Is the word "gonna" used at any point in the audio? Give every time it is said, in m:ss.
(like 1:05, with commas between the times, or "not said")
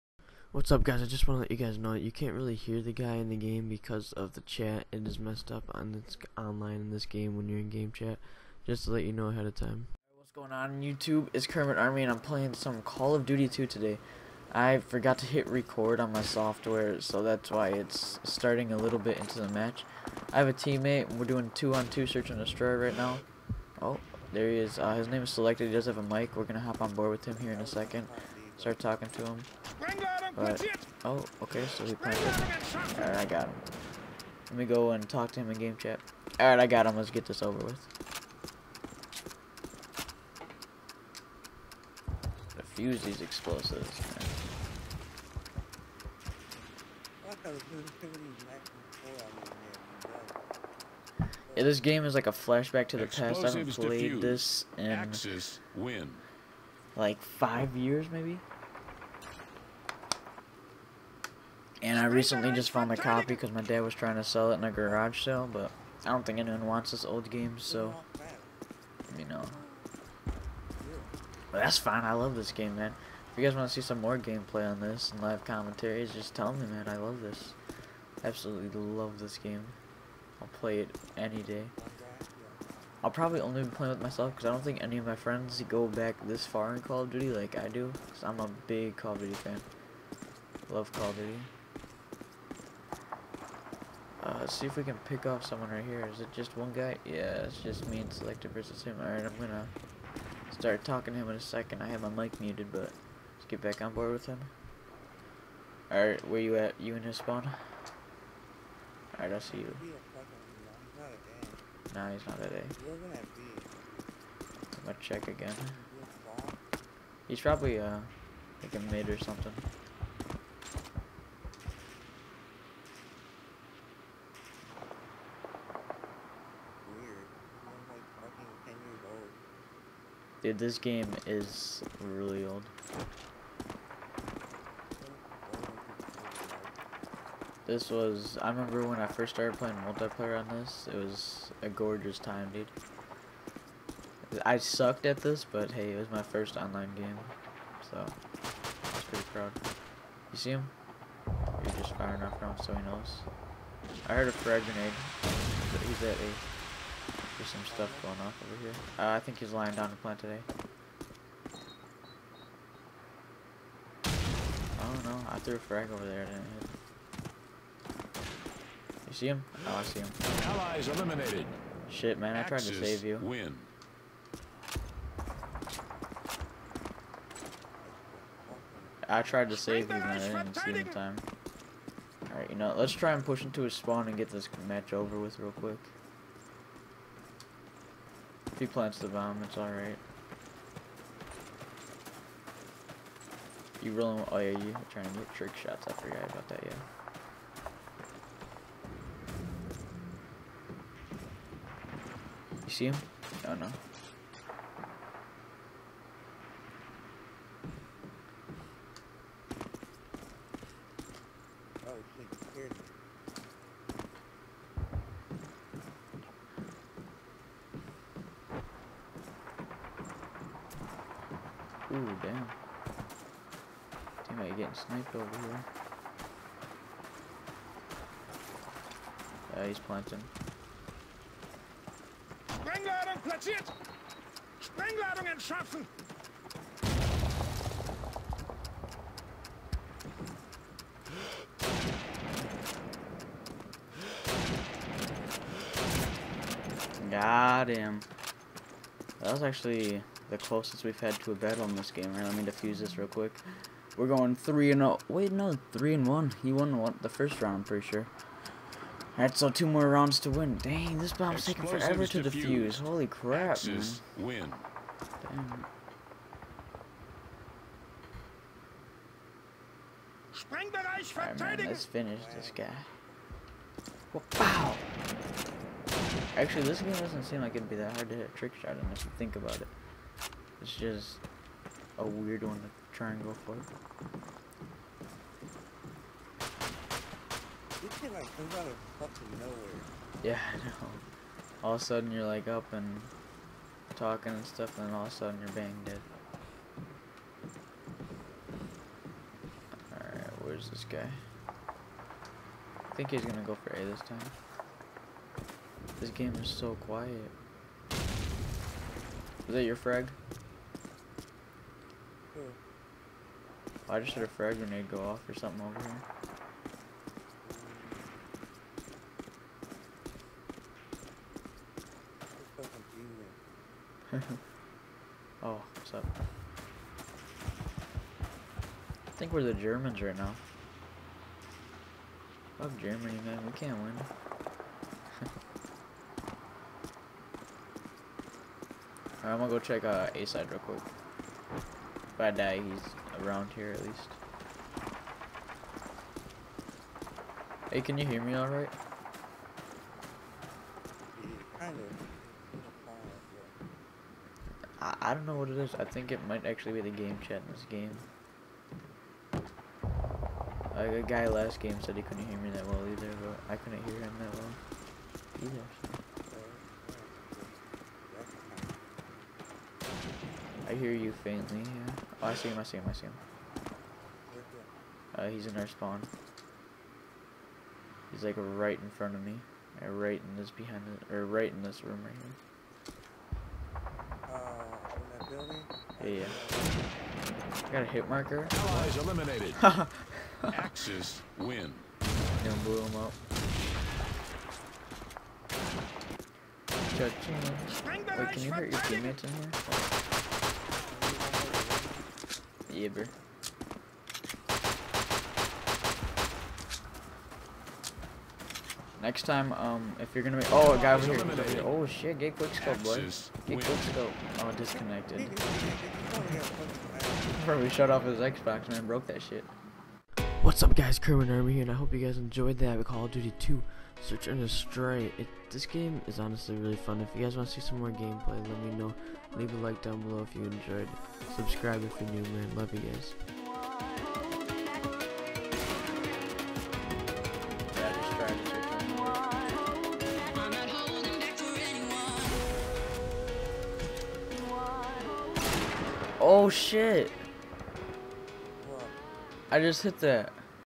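1:39, 1:54, 5:03, 5:39, 6:50.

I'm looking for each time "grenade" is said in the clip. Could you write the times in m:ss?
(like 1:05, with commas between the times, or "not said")
2:34, 5:14.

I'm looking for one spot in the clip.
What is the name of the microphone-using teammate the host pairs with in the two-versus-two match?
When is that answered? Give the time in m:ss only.
0:25.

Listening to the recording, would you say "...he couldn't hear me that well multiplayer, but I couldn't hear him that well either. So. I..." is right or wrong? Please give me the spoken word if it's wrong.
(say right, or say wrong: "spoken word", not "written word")
wrong: "either", not "multiplayer".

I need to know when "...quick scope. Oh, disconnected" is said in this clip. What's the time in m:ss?
6:53.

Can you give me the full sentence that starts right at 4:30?
Alright, man, let's finish this guy.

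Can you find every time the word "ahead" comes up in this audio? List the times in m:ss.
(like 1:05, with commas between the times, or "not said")
0:09.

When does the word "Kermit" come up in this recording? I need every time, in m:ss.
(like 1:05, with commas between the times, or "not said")
0:11, 7:00.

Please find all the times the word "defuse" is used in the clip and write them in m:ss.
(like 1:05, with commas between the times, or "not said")
0:42, 4:12, 4:22.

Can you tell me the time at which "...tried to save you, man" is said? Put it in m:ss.
2:59.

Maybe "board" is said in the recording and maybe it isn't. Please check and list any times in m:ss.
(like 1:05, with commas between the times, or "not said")
0:26, 1:43.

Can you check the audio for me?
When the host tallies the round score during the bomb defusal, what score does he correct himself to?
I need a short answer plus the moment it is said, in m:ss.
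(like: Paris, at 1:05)
3 and 1, at 4:15.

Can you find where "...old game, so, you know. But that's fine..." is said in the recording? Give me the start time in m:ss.
1:07.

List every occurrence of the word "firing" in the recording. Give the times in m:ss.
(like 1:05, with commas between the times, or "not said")
2:31.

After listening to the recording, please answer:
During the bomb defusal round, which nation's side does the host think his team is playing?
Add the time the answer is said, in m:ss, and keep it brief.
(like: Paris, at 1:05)
the Germans, at 5:29.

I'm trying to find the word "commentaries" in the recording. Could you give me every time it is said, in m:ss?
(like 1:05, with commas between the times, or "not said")
1:15.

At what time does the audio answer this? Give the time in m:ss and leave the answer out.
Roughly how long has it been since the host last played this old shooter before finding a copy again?
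0:57.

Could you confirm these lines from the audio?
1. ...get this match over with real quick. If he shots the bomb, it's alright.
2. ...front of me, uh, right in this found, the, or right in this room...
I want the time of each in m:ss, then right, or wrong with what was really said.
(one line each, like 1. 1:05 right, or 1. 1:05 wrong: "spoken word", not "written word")
1. 3:04 wrong: "plants", not "shots"
2. 6:18 wrong: "behind", not "found".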